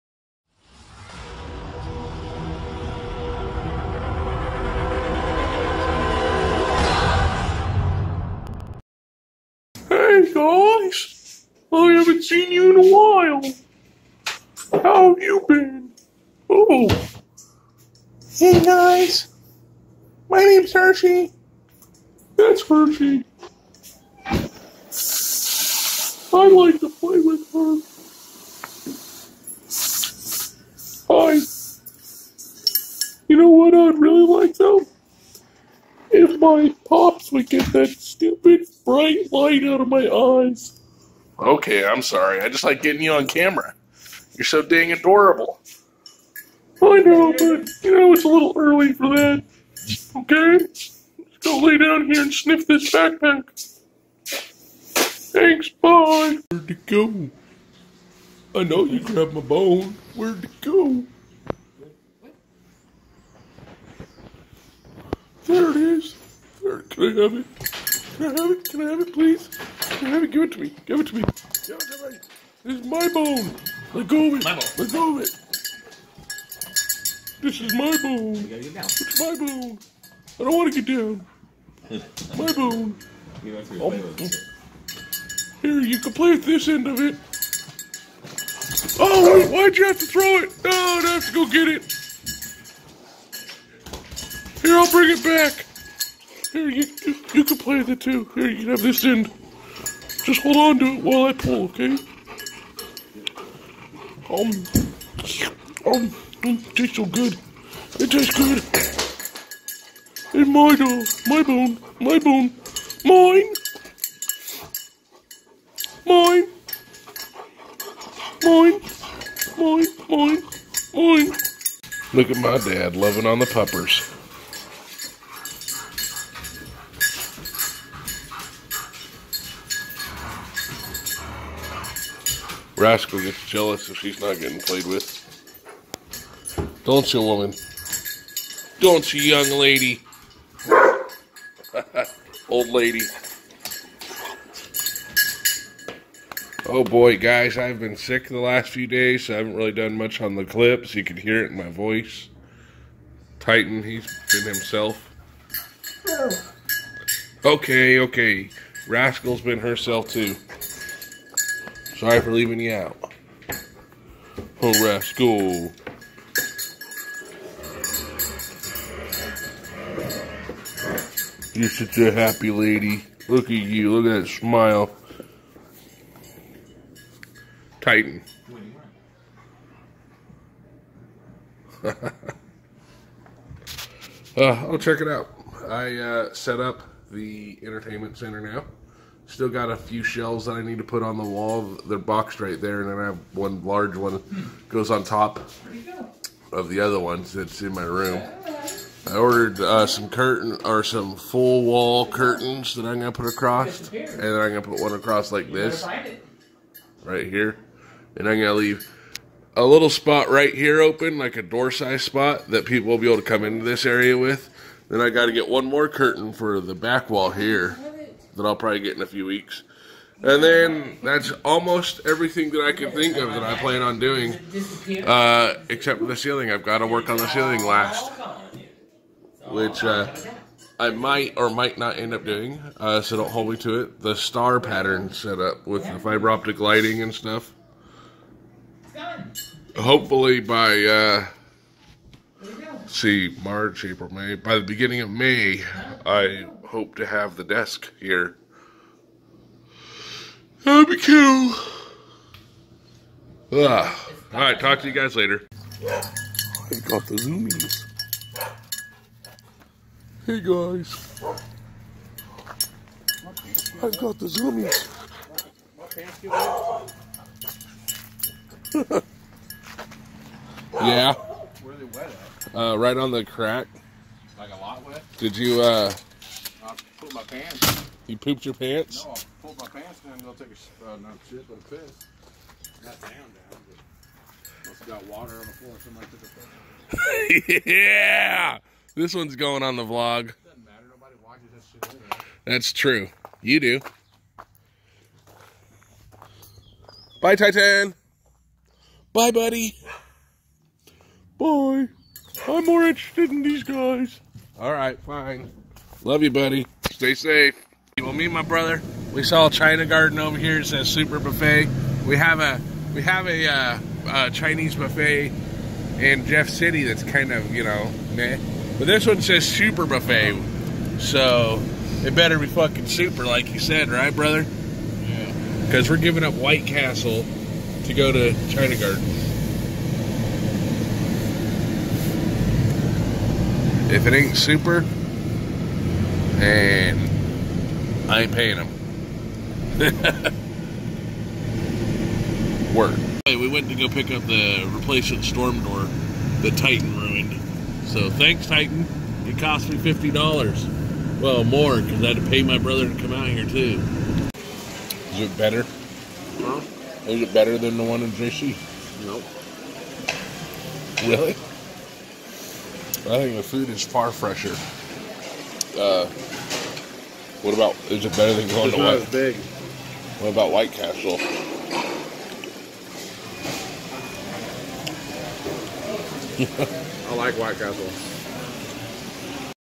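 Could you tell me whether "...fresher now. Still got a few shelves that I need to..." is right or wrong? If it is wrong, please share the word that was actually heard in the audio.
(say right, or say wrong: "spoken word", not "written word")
wrong: "center", not "fresher".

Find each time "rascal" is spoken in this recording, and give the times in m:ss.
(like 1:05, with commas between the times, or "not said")
2:12, 2:38, 2:44.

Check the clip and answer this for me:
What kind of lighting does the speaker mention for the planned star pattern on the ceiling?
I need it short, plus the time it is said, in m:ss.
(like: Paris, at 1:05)
Fiber optic, at 3:55.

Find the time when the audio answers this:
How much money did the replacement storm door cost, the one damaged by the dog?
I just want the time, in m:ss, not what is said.
5:49.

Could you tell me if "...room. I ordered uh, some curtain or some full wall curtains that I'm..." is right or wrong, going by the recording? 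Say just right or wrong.
right.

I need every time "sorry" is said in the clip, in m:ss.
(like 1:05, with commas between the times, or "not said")
0:42, 2:42.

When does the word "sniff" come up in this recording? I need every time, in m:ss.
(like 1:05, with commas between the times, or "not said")
0:52.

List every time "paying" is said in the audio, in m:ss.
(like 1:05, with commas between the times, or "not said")
5:38.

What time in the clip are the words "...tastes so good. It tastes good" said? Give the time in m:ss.
1:46.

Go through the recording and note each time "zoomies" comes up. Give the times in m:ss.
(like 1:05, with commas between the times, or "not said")
4:17, 4:24.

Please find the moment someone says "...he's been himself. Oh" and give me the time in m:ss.
2:33.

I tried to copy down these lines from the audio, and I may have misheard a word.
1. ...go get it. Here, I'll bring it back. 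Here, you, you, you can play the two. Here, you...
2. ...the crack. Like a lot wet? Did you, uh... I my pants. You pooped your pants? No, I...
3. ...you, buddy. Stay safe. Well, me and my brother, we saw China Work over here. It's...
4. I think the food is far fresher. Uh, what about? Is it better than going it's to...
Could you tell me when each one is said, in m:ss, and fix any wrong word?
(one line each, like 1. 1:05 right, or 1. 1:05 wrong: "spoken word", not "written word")
1. 1:31 right
2. 4:33 right
3. 5:06 wrong: "Garden", not "Work"
4. 6:03 right.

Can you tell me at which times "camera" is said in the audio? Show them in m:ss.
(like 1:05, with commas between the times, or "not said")
0:43.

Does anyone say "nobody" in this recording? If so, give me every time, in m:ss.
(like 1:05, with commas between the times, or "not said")
4:50.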